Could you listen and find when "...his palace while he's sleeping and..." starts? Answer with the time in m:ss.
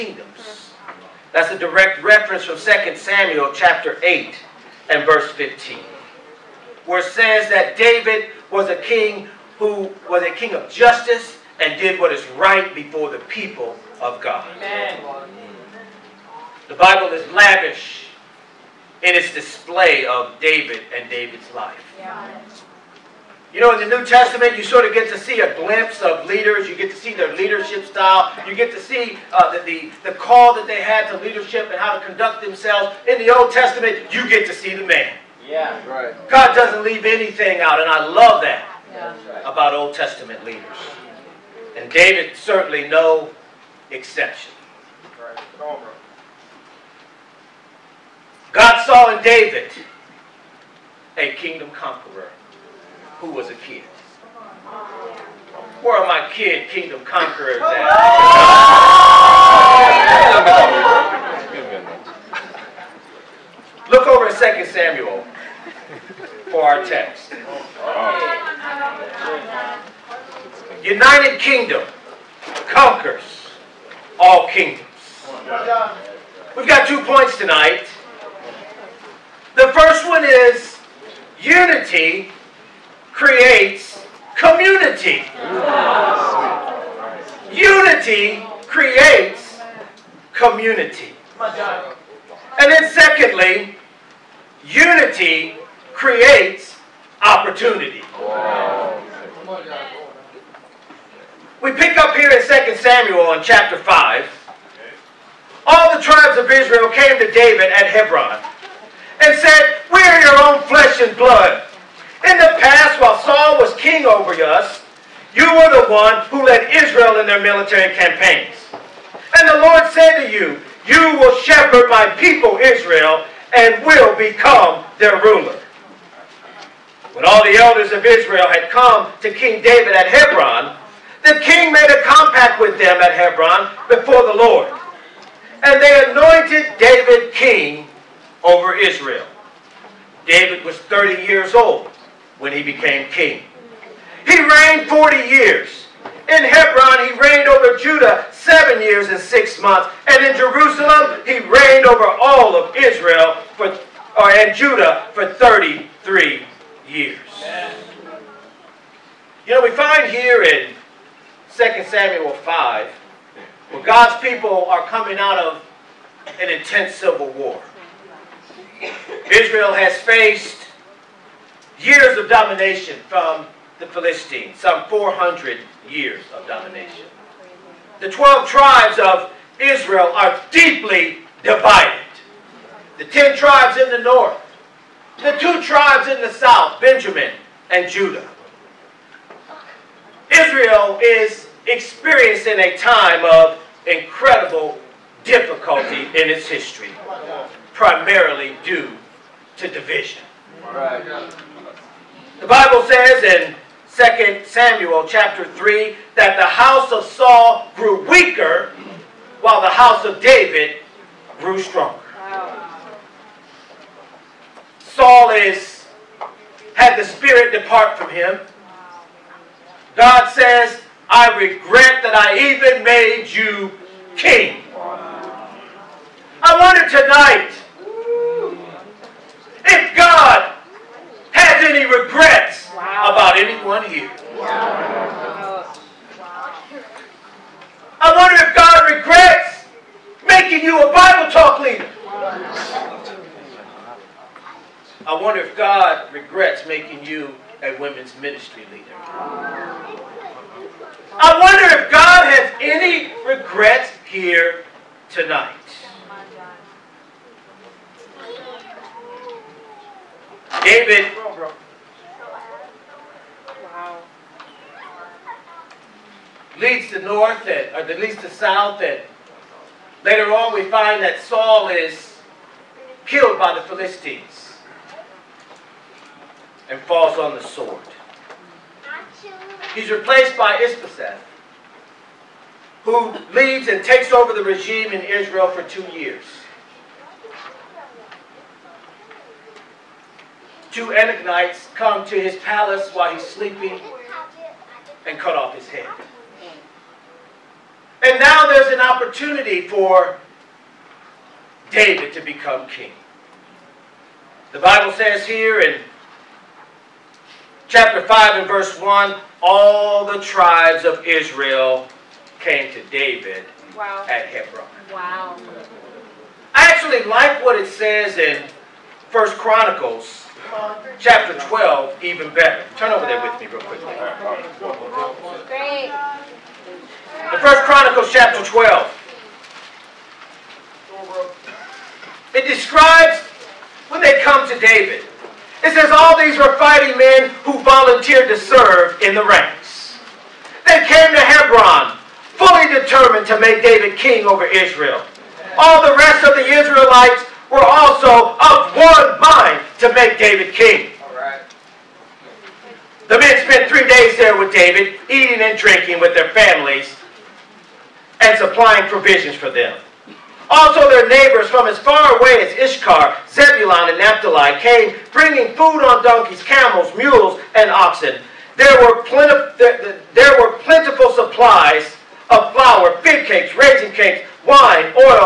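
4:52.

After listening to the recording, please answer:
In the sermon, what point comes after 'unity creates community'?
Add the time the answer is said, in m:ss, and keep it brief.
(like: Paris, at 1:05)
Unity creates opportunity, at 1:34.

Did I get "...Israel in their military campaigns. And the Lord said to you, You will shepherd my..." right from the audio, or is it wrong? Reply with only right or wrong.
right.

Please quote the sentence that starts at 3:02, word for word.
The 10 tribes in the north, the two tribes in the south, Benjamin and Judah.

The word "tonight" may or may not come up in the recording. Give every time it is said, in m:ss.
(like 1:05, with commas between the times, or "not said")
1:17, 3:46, 4:15.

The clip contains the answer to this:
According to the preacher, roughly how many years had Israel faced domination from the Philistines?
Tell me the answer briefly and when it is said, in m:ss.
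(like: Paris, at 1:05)
400, at 2:54.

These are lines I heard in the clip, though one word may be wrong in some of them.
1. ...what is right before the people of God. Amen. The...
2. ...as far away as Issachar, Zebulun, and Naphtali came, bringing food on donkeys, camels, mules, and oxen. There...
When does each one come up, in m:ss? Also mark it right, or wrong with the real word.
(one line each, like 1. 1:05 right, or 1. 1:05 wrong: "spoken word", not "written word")
1. 0:11 right
2. 6:01 right.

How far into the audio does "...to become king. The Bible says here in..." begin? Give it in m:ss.
5:02.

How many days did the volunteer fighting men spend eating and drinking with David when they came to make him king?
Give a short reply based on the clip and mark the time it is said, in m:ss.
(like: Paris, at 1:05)
3, at 5:53.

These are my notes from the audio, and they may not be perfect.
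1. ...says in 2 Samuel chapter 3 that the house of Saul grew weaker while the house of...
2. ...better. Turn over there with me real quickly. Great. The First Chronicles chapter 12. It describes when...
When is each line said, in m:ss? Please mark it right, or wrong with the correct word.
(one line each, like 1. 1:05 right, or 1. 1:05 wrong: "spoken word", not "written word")
1. 3:22 right
2. 5:22 right.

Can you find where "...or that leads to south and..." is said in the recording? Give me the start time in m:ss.
4:27.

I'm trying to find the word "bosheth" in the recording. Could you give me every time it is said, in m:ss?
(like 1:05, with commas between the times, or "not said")
4:40.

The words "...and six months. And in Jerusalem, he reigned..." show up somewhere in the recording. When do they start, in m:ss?
2:29.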